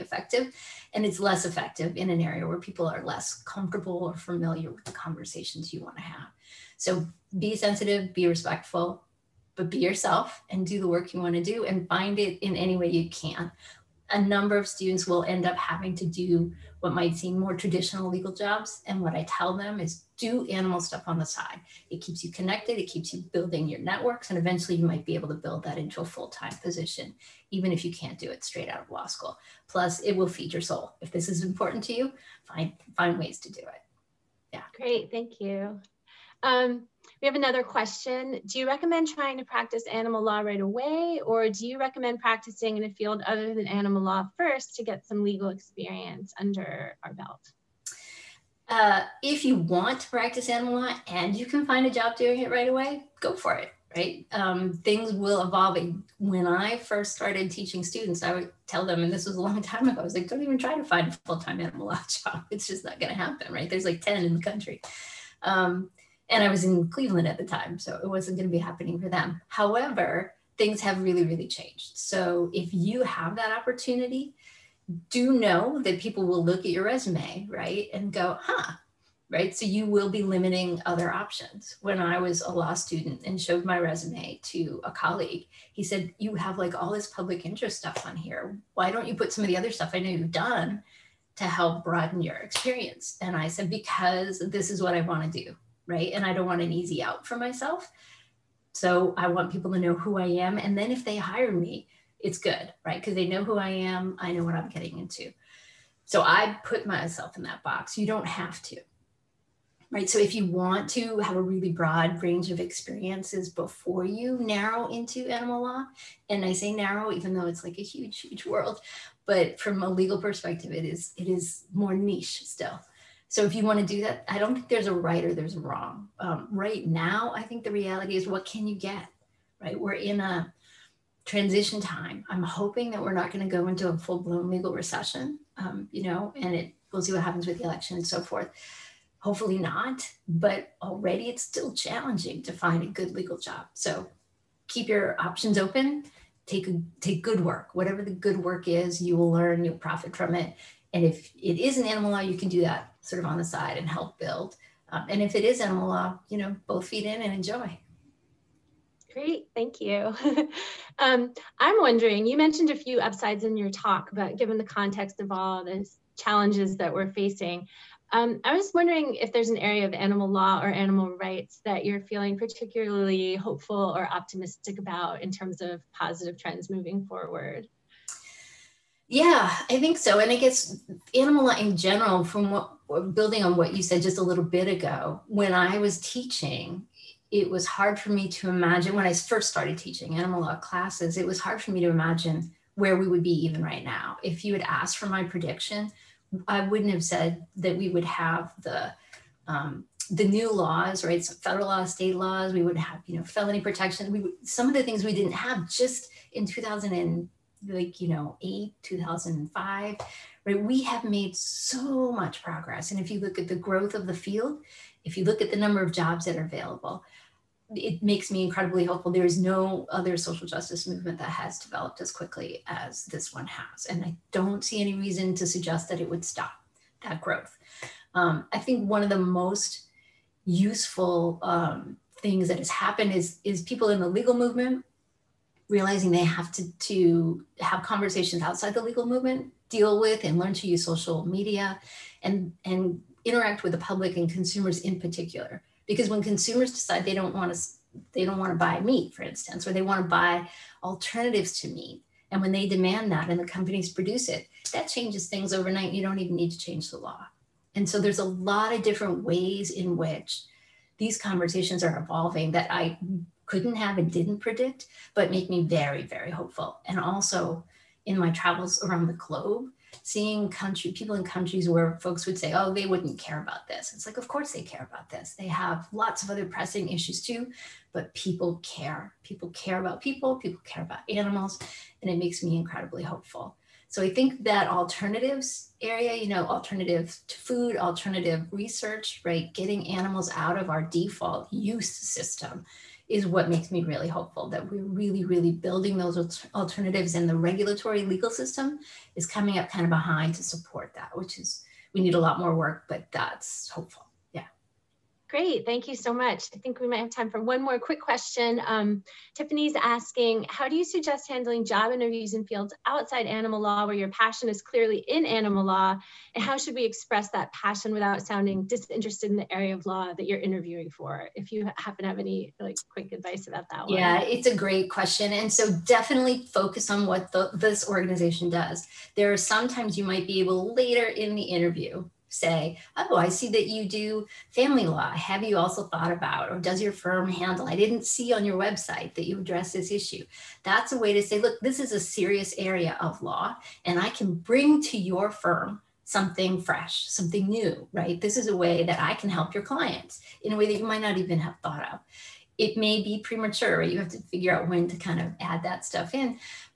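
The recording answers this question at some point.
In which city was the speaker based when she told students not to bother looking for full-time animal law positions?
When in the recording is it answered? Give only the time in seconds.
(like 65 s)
66 s.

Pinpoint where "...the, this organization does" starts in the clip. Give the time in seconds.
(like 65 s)
327 s.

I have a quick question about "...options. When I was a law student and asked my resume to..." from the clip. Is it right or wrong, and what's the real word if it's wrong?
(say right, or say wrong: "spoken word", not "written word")
wrong: "showed", not "asked".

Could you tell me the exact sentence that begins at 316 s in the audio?
And how should we express that passion without sounding disinterested in the area of law that you're interviewing for?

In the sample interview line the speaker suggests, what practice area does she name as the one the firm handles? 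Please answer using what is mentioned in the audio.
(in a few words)
Family law.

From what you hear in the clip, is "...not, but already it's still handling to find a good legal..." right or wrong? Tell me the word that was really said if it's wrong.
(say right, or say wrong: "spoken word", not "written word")
wrong: "challenging", not "handling".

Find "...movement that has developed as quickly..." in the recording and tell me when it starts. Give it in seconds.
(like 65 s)
220 s.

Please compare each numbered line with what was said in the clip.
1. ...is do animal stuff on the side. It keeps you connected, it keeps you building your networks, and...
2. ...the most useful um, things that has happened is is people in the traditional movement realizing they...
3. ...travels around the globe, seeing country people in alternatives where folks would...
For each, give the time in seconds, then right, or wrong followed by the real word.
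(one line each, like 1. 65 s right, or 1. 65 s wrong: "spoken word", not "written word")
1. 19 s right
2. 229 s wrong: "legal", not "traditional"
3. 268 s wrong: "countries", not "alternatives".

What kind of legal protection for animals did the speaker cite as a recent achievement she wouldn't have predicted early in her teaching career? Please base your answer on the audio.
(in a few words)
Felony protection.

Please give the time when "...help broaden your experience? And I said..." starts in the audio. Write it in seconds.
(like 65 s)
91 s.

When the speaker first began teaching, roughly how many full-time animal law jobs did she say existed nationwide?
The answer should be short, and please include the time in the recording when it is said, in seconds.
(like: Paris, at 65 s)
10, at 64 s.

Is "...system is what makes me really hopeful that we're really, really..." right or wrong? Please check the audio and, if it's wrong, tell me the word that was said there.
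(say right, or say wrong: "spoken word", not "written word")
right.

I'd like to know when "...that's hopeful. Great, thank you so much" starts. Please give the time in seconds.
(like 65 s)
303 s.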